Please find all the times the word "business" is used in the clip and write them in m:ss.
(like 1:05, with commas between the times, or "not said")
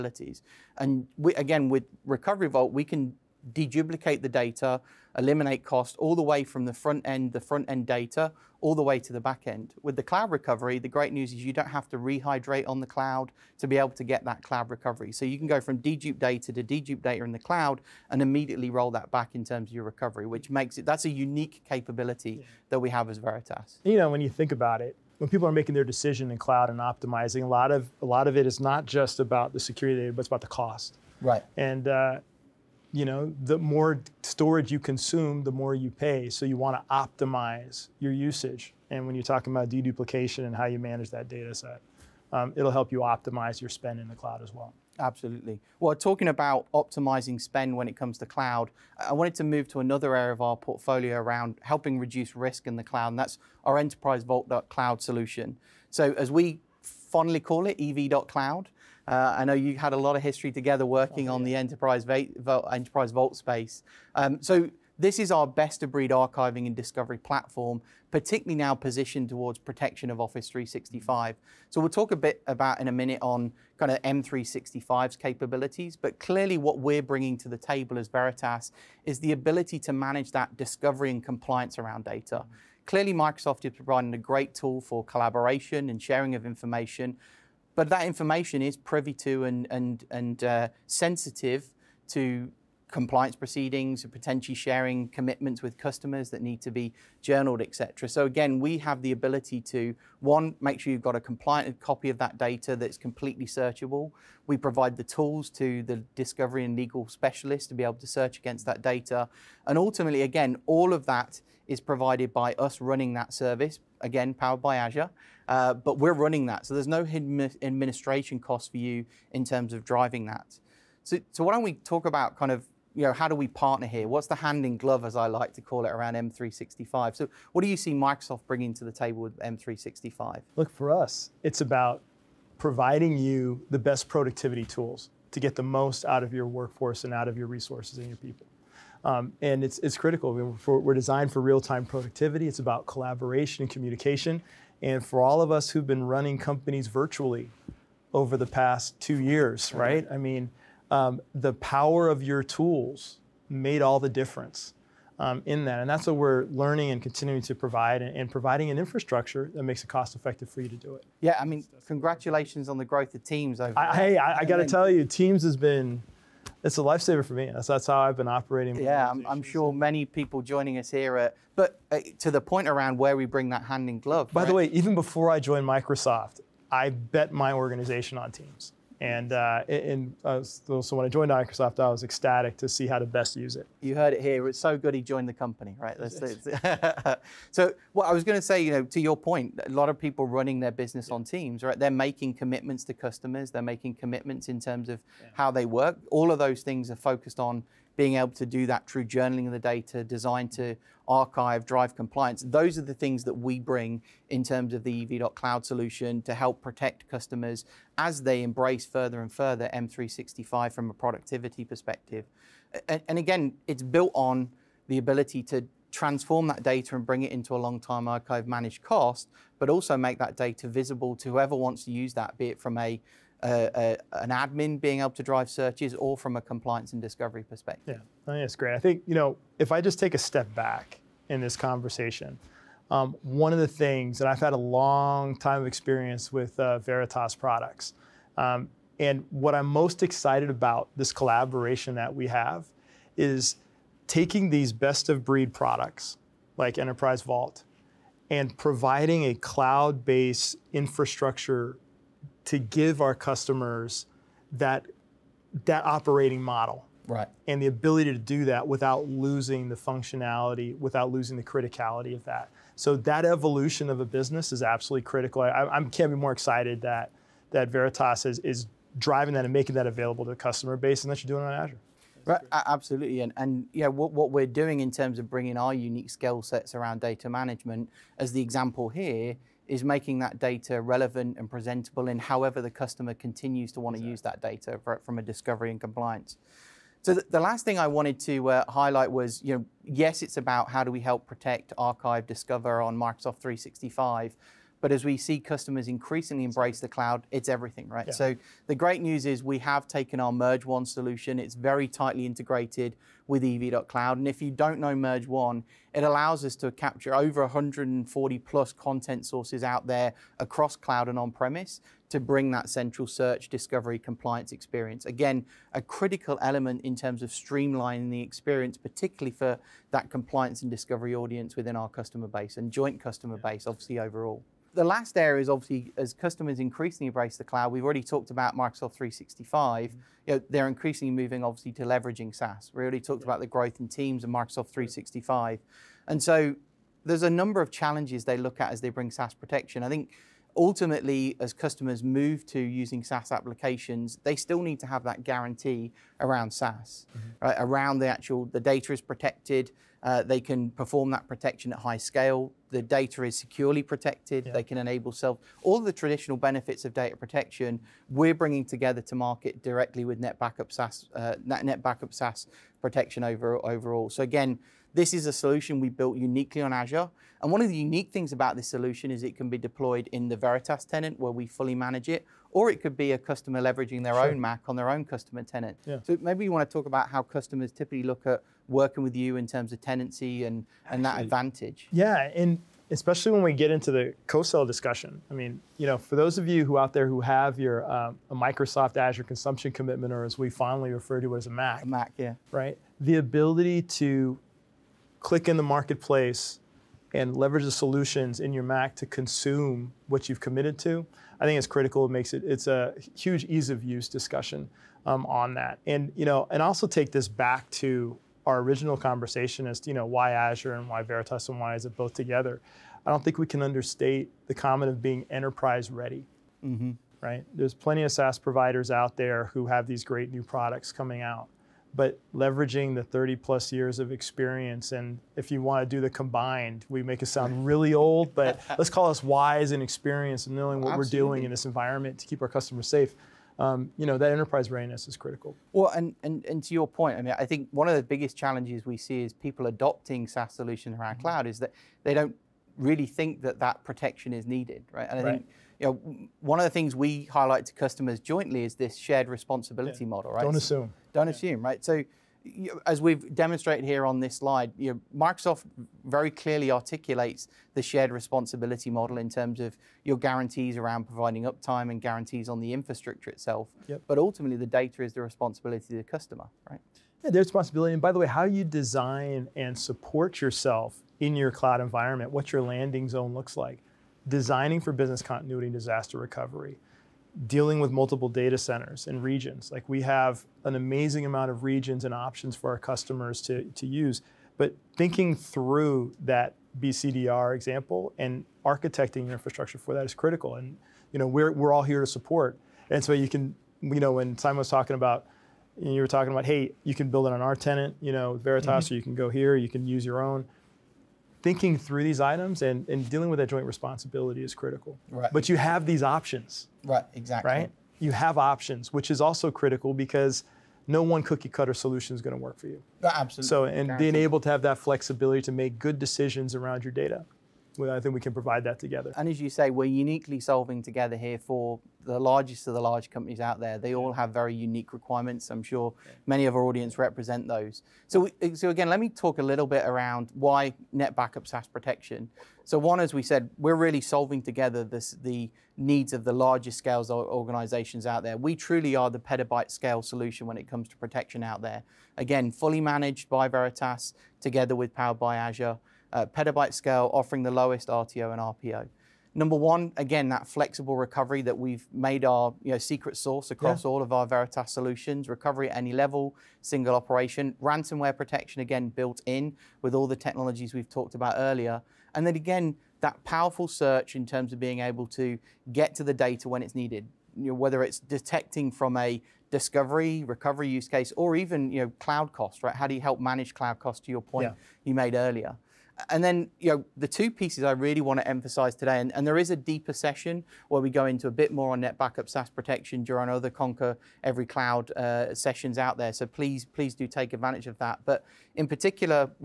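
3:10, 4:24, 7:54.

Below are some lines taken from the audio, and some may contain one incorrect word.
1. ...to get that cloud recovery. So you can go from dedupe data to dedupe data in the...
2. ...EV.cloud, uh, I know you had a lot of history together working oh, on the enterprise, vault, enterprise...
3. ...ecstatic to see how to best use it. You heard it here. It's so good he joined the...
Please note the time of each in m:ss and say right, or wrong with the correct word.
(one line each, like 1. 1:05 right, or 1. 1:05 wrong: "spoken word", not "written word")
1. 0:13 right
2. 0:57 right
3. 3:02 right.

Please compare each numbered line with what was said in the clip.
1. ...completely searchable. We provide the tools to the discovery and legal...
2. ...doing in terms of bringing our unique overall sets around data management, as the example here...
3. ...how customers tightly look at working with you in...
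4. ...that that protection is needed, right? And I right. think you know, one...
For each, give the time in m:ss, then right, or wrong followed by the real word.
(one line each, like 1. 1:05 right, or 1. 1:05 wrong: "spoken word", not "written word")
1. 1:42 right
2. 4:34 wrong: "skill", not "overall"
3. 6:17 wrong: "typically", not "tightly"
4. 7:23 right.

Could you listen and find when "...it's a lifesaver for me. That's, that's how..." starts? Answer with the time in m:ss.
2:46.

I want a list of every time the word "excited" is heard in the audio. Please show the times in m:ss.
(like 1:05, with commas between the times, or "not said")
4:00, 4:26.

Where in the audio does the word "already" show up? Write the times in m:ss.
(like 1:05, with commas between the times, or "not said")
5:27, 5:32.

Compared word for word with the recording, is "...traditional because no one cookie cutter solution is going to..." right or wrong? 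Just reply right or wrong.
wrong.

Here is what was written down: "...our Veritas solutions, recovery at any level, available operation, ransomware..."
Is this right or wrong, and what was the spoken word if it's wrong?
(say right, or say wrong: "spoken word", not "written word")
wrong: "single", not "available".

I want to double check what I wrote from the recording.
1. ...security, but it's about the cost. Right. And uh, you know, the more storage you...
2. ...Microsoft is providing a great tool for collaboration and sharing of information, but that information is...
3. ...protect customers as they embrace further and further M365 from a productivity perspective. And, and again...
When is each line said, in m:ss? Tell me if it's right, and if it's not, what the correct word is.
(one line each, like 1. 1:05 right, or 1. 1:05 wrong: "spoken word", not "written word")
1. 0:29 right
2. 1:23 right
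3. 3:26 right.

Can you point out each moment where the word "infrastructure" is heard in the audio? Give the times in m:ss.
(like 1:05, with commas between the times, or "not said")
2:38, 4:10, 7:42, 8:09.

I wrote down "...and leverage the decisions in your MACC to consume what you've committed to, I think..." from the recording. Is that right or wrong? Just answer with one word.
wrong.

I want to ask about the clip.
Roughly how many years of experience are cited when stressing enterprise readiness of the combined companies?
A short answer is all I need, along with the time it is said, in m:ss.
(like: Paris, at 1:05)
30 plus years, at 7:03.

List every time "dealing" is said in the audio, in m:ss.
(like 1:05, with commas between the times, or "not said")
7:57, 8:23.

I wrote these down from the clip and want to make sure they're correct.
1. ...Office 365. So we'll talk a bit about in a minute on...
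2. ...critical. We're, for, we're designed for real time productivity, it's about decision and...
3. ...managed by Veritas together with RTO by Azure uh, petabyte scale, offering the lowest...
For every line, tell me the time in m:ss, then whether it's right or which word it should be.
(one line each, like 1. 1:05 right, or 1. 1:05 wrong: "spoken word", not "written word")
1. 1:10 right
2. 2:19 wrong: "collaboration", not "decision"
3. 9:02 wrong: "Powered", not "RTO".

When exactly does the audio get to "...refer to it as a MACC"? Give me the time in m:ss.
6:30.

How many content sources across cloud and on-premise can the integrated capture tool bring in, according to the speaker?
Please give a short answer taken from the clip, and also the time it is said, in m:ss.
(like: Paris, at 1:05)
over 140, at 5:07.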